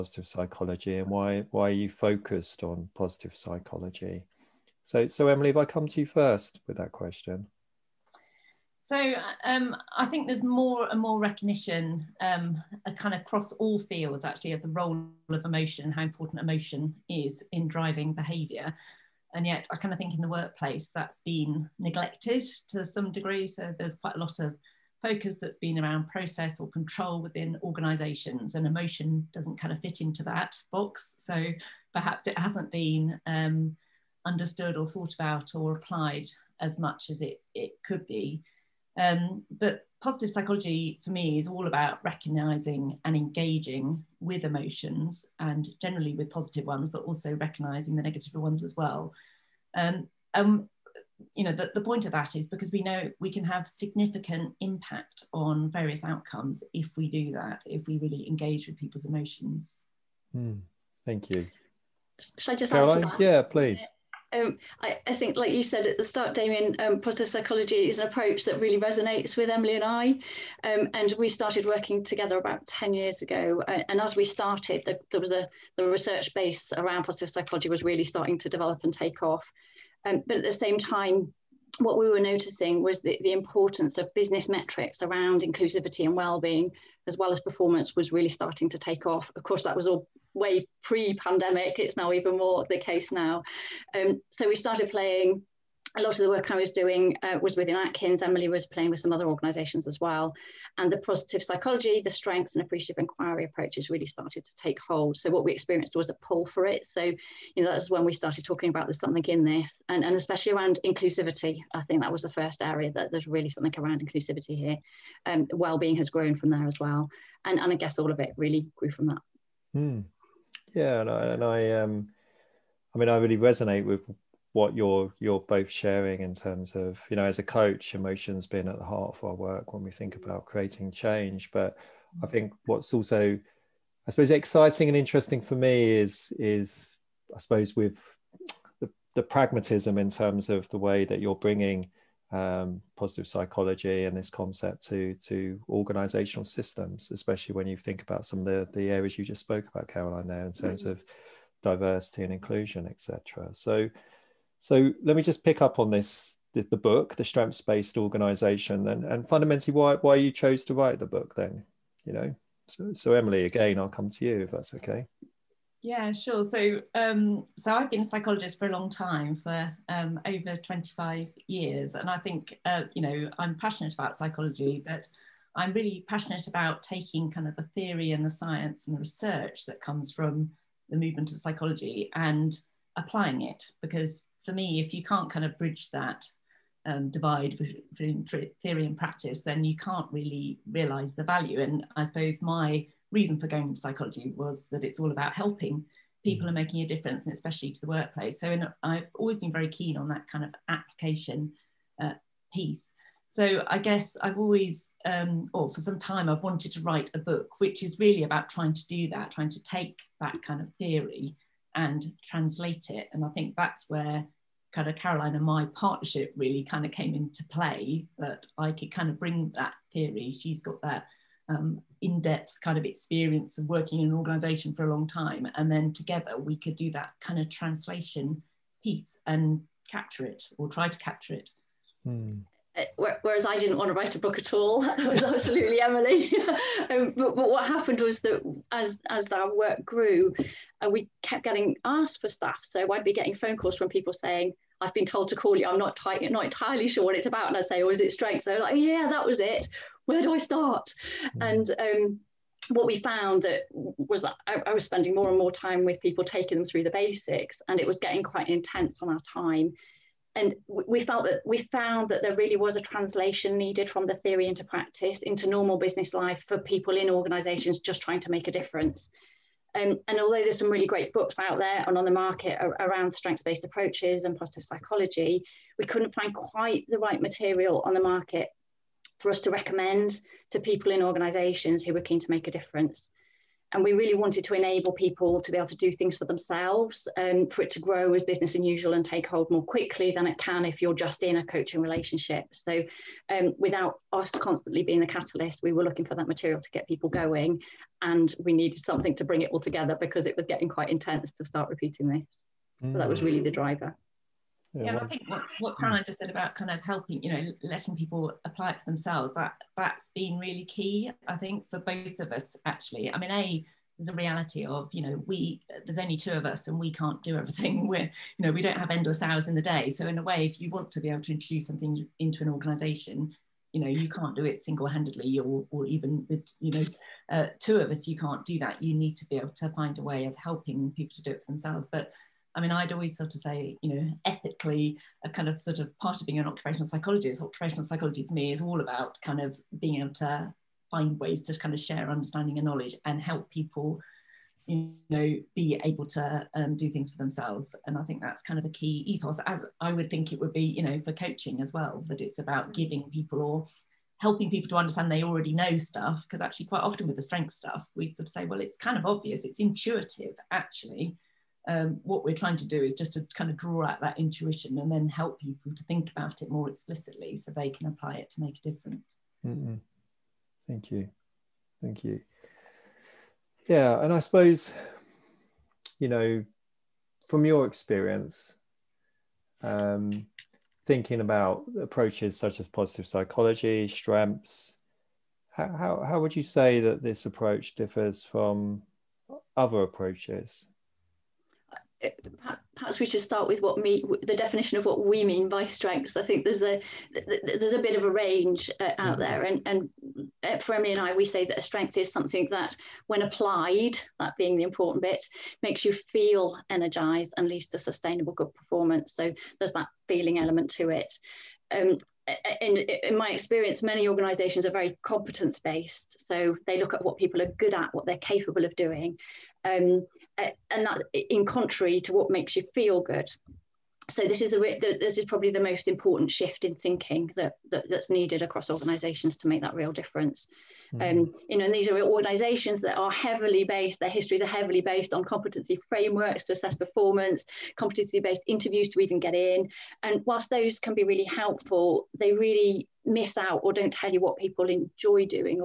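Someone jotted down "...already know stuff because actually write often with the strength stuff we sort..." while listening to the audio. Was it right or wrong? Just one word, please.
wrong.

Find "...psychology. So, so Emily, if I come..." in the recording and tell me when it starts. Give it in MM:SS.
00:03.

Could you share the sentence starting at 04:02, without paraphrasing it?
So I'd be getting phone calls from people saying, I've been told to call you.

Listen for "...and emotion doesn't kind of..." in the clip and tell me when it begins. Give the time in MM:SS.
00:28.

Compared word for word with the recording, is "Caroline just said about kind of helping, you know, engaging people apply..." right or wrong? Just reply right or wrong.
wrong.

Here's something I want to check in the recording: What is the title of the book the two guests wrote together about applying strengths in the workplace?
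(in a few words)
The Strengths Based Organization.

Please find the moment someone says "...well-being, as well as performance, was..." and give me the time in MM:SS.
01:26.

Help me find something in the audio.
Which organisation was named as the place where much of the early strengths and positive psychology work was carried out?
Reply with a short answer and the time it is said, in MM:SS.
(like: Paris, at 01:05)
Atkins, at 01:37.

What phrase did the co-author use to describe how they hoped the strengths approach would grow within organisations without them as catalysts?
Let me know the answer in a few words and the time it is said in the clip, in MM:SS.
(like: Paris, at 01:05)
business unusual, at 04:48.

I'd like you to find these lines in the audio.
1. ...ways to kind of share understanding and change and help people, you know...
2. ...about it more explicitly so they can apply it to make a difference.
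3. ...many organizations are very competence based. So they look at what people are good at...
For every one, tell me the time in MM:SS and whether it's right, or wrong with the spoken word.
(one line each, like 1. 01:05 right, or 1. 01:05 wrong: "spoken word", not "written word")
1. 05:41 wrong: "knowledge", not "change"
2. 06:06 right
3. 06:53 right.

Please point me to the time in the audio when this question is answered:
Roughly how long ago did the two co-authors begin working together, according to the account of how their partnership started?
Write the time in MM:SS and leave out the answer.
01:12.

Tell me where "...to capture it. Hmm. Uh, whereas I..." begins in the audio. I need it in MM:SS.
03:50.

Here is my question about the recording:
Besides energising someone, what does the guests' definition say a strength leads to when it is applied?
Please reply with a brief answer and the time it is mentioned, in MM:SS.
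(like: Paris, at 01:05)
sustainable good performance, at 06:47.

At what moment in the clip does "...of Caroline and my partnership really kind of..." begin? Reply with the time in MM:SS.
03:34.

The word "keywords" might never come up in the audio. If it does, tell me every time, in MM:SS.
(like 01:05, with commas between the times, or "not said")
not said.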